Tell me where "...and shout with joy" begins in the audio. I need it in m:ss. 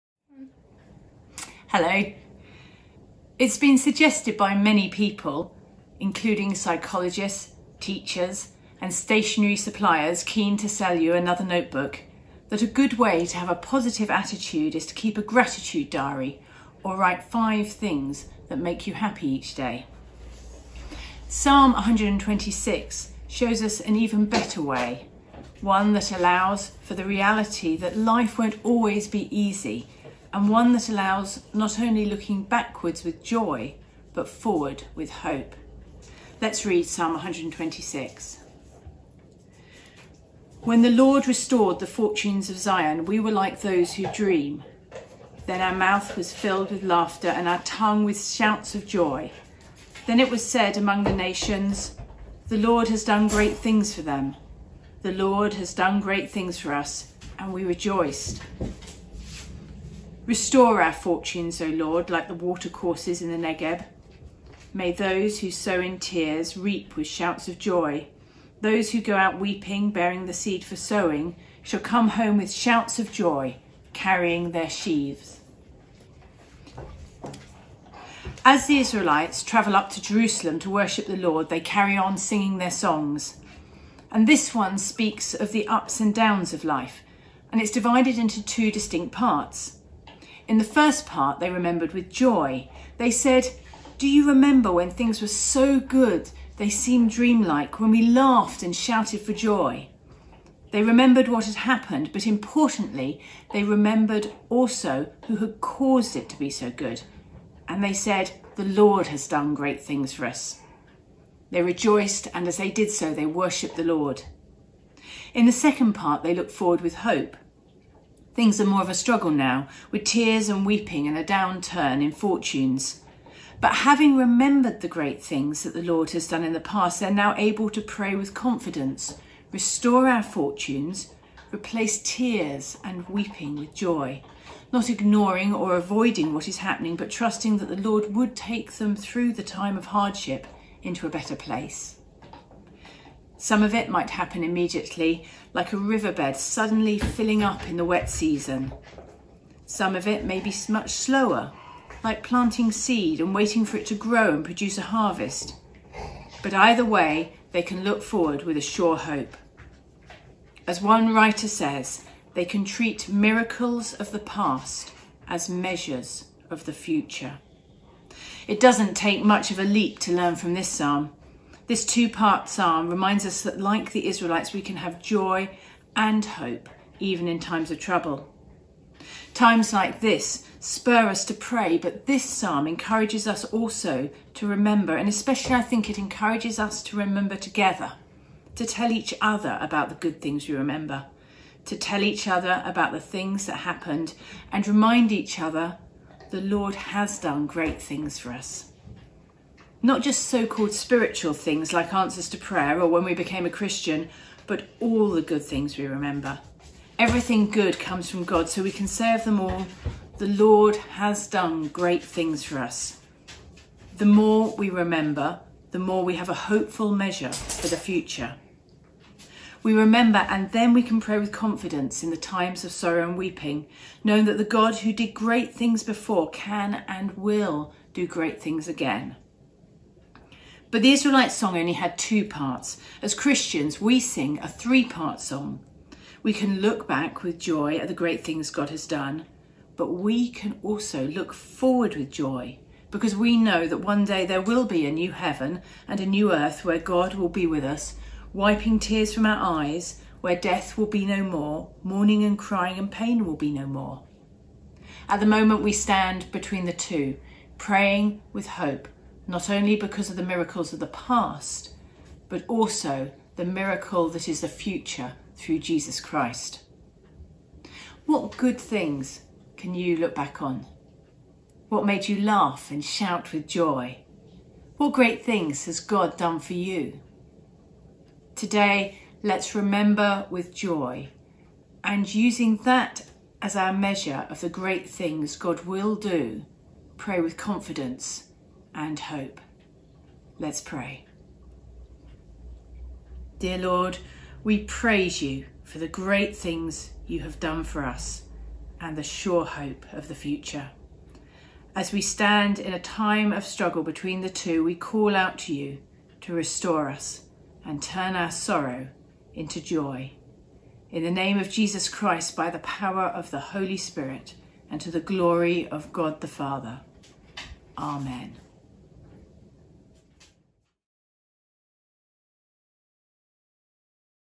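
4:32.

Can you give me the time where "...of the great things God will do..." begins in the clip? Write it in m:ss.
4:44.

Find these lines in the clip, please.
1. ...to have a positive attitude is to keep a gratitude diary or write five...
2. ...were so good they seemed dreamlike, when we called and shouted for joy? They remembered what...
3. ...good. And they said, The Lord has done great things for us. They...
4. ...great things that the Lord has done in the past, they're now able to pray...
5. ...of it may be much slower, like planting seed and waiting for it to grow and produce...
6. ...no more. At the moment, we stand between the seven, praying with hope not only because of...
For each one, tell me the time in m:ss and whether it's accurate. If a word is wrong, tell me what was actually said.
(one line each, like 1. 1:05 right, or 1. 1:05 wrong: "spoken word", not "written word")
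1. 0:13 right
2. 1:35 wrong: "laughed", not "called"
3. 1:46 right
4. 2:04 right
5. 2:29 right
6. 4:13 wrong: "two", not "seven".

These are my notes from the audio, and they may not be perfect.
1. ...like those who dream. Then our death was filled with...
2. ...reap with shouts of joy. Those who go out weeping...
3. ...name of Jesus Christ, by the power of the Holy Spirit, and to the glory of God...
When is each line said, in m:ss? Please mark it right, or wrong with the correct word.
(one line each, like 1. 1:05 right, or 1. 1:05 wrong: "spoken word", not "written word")
1. 0:43 wrong: "mouth", not "death"
2. 1:06 right
3. 5:11 right.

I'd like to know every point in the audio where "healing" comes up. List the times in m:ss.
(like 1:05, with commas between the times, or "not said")
not said.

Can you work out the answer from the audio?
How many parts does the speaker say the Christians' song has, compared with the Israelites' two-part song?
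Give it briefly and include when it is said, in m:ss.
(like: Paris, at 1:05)
3, at 3:54.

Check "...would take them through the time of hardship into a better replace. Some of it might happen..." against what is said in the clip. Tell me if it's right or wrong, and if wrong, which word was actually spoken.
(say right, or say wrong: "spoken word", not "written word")
wrong: "place", not "replace".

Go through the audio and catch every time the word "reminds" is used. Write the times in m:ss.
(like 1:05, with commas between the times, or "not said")
2:52, 3:14.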